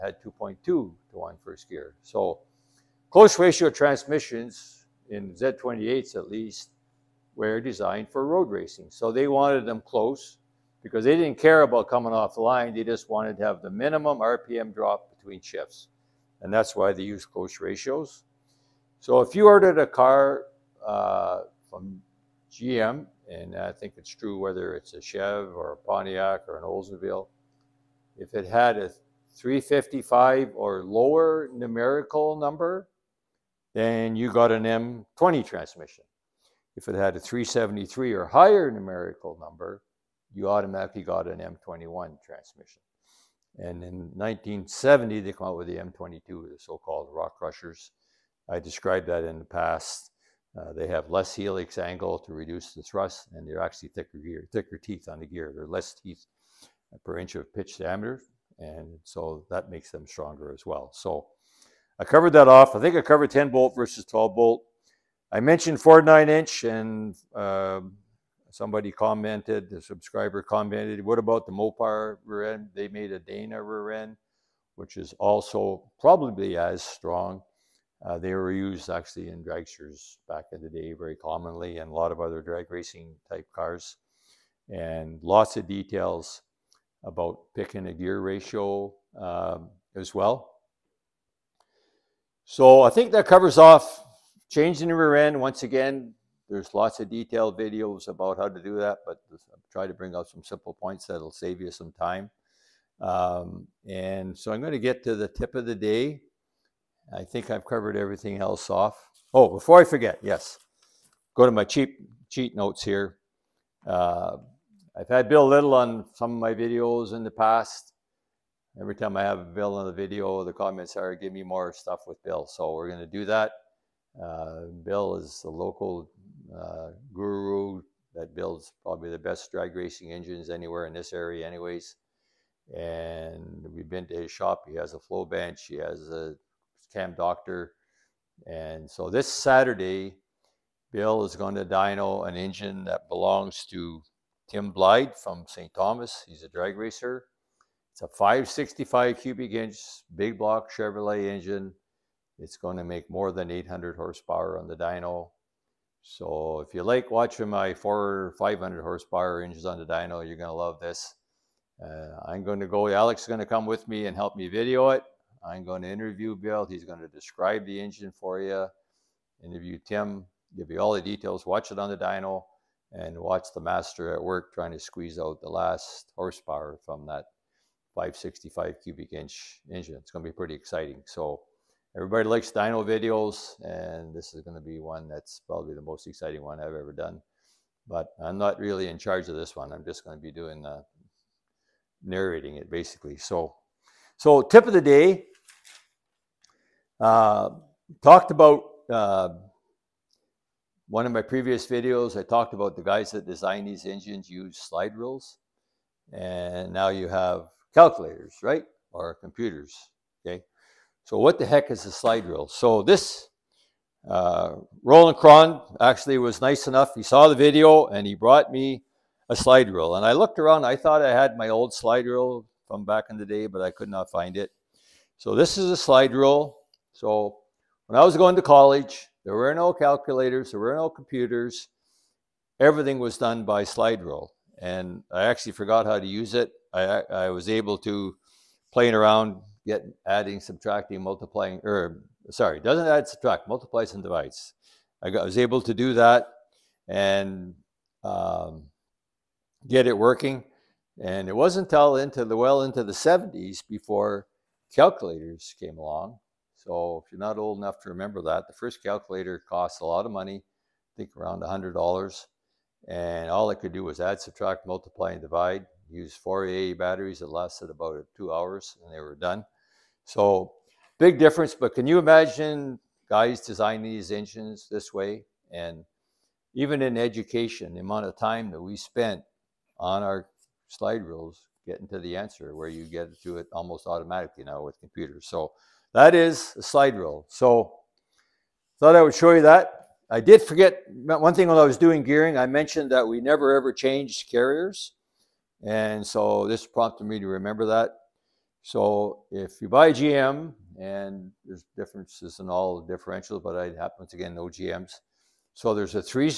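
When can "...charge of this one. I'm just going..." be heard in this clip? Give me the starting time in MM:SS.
03:08.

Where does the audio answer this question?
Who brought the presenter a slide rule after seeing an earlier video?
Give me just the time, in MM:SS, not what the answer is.
03:34.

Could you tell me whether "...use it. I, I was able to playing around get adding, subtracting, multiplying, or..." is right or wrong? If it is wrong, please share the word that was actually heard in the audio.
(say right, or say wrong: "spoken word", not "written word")
right.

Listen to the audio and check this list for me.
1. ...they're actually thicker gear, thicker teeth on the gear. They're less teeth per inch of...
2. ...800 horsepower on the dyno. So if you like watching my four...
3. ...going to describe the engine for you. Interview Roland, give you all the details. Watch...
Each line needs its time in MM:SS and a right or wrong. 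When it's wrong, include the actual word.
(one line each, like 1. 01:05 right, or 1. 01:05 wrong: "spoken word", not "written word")
1. 00:53 right
2. 02:33 right
3. 02:46 wrong: "Tim", not "Roland".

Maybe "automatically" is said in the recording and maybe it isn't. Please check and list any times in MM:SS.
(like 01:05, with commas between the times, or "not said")
00:40, 04:43.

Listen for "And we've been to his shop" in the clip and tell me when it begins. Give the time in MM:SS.
02:12.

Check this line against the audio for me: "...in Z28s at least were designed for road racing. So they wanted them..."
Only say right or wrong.
right.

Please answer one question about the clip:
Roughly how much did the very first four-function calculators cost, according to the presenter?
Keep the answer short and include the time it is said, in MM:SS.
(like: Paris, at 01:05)
$100, at 04:21.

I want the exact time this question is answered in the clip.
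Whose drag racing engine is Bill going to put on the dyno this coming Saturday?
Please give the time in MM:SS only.
02:24.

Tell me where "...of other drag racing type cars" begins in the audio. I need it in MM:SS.
01:22.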